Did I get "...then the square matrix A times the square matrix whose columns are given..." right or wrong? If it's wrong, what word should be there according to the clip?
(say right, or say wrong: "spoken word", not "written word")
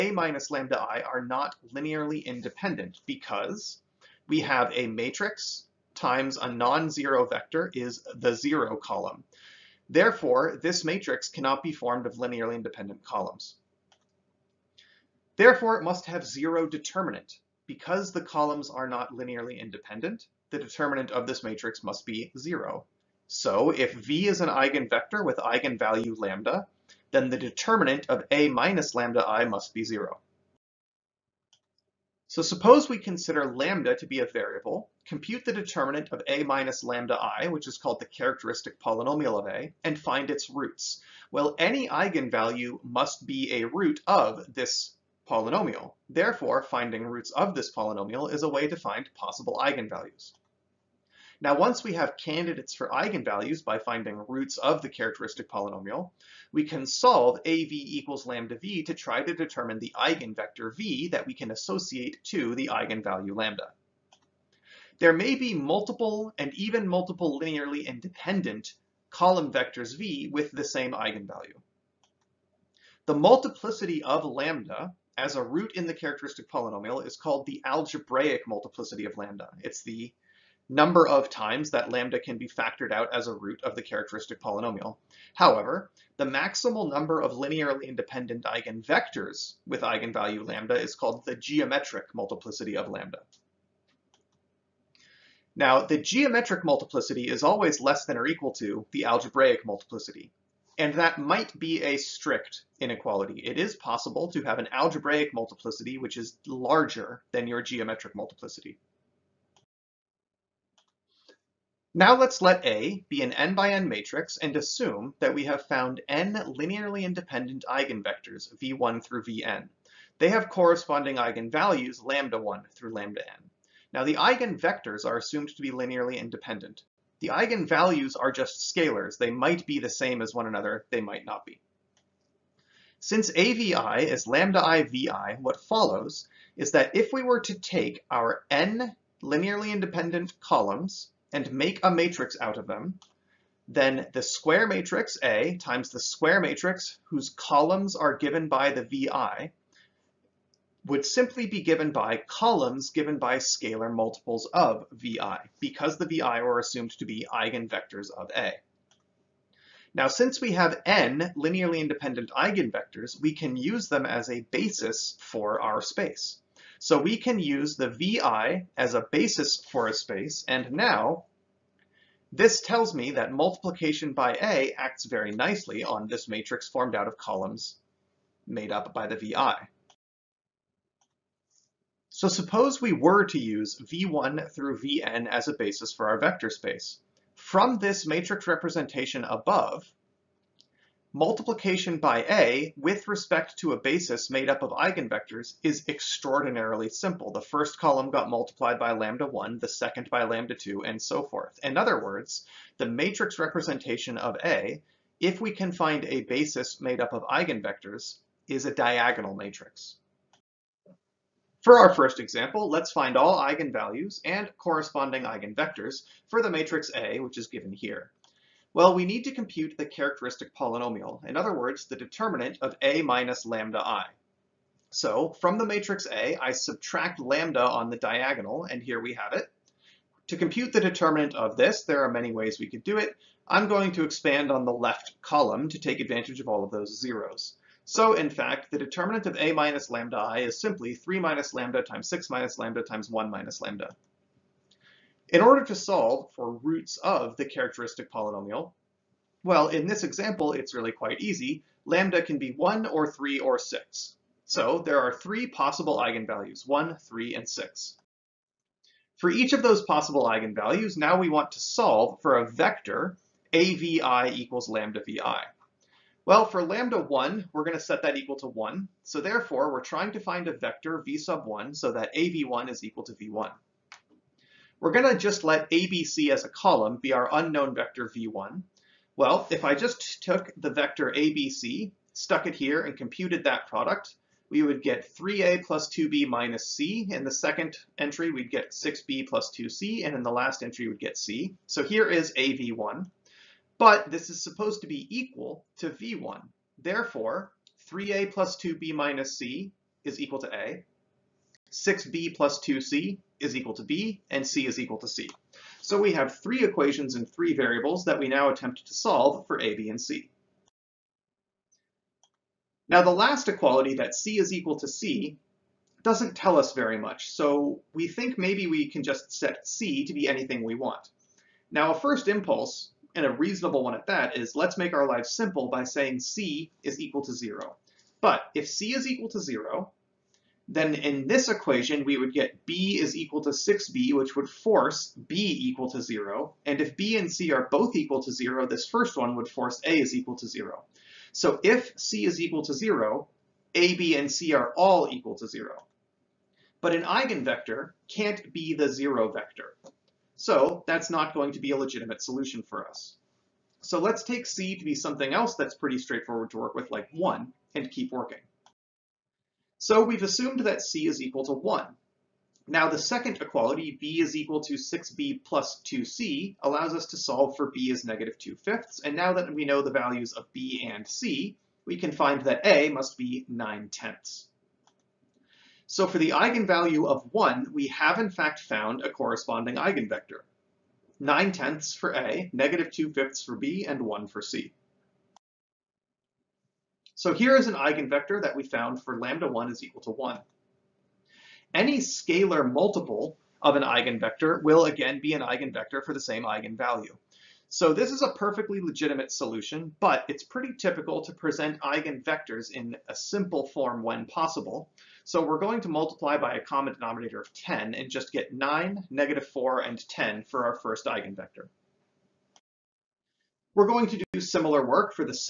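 right.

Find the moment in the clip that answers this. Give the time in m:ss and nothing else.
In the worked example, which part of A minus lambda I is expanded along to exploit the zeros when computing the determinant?
3:54.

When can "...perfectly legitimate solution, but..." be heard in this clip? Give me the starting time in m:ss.
6:38.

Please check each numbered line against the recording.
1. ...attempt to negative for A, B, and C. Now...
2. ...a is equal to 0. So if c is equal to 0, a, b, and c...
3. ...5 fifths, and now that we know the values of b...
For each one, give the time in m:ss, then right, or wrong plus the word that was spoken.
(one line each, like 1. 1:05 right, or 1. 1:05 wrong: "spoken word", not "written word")
1. 5:08 wrong: "solve", not "negative"
2. 5:39 right
3. 6:08 wrong: "2", not "5".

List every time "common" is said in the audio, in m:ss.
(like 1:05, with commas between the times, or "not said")
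6:46.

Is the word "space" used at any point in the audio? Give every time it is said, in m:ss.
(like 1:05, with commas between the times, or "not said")
2:45, 2:49, 3:06.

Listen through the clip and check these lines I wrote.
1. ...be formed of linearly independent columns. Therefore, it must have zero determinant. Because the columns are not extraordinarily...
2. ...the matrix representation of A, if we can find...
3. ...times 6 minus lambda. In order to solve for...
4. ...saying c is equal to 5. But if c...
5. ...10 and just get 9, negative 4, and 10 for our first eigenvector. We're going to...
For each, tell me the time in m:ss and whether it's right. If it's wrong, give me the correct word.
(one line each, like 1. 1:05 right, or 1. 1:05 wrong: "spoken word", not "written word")
1. 0:11 wrong: "linearly", not "extraordinarily"
2. 3:22 right
3. 4:02 wrong: "1", not "6"
4. 5:25 wrong: "0", not "5"
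5. 6:47 right.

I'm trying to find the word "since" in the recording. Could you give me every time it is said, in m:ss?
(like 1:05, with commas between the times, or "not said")
2:12, 2:40.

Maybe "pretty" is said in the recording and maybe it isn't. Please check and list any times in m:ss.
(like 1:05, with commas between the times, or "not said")
5:55, 6:40.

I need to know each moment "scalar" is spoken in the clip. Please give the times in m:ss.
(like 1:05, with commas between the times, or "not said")
2:08, 2:33, 6:31.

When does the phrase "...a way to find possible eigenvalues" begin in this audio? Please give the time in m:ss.
0:48.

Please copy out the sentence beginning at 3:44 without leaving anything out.
So from the matrix A, I subtract lambda on the diagonal, and here we have it.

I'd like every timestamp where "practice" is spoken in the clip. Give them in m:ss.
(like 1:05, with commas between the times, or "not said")
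not said.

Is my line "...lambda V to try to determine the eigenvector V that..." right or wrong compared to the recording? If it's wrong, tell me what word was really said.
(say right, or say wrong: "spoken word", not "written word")
right.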